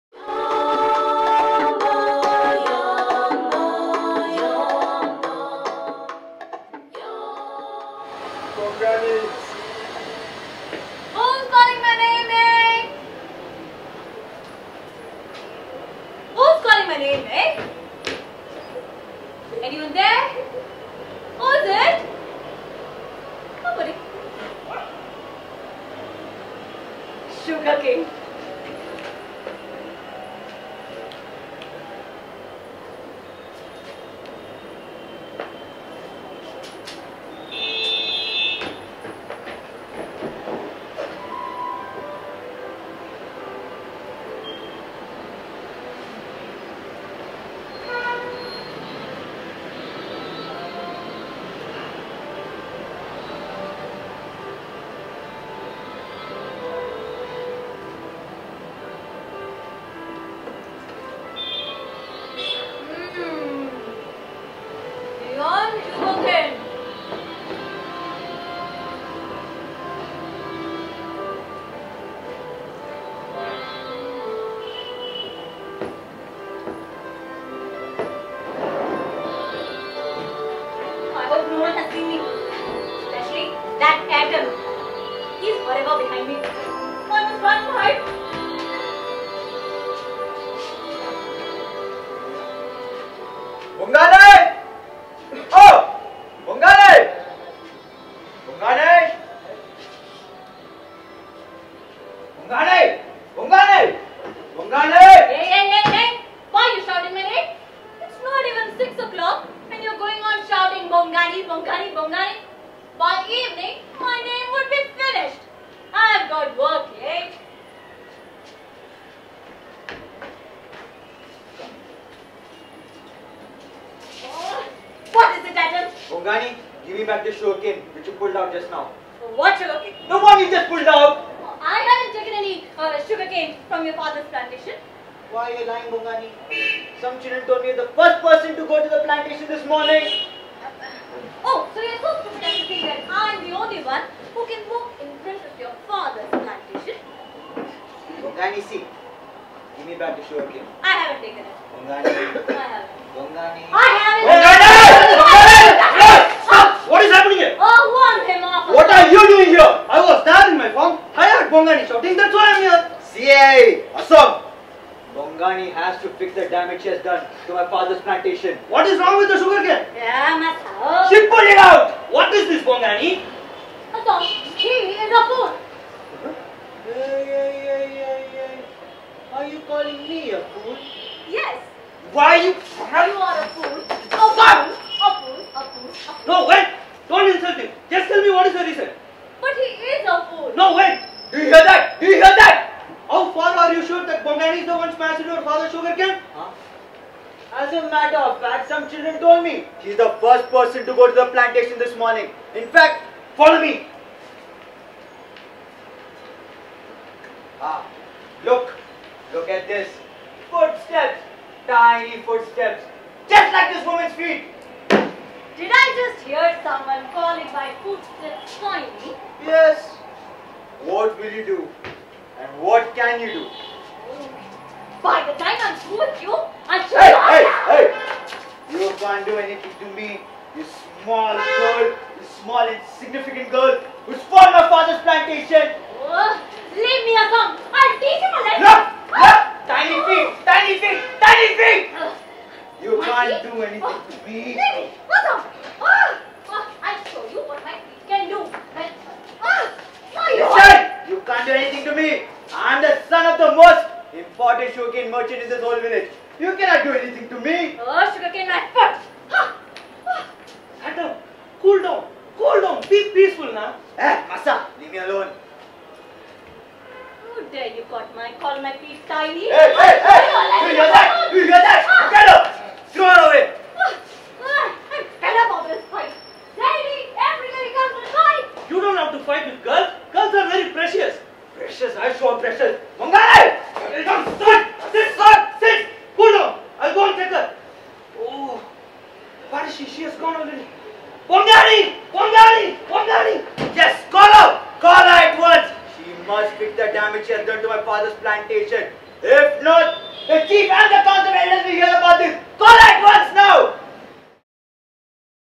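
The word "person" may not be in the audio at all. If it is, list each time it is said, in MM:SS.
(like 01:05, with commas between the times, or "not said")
02:18, 03:20.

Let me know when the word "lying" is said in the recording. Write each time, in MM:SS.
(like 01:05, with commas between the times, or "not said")
02:15.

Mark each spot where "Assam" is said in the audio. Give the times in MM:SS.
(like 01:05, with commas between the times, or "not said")
02:43, 02:53.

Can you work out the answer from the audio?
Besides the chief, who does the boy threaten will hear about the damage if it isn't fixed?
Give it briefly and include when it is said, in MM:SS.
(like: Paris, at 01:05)
The council elders, at 05:00.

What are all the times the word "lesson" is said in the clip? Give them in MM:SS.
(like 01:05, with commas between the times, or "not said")
03:58.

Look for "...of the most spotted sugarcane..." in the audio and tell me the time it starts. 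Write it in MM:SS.
04:13.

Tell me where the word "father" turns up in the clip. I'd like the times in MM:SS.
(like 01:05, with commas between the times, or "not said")
02:13, 02:25, 02:47, 03:54, 04:57.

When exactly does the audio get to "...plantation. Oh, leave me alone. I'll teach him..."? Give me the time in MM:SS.
03:55.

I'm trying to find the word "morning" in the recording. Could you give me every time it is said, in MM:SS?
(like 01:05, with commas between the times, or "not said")
02:19, 03:21.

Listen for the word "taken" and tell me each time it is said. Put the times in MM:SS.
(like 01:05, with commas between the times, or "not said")
02:12, 02:31.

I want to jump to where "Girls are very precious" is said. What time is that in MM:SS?
04:40.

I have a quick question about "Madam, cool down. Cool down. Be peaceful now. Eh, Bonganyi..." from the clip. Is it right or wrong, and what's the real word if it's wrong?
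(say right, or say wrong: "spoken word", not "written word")
wrong: "Masa", not "Bonganyi".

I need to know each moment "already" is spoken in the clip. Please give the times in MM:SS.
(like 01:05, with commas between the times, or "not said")
04:50.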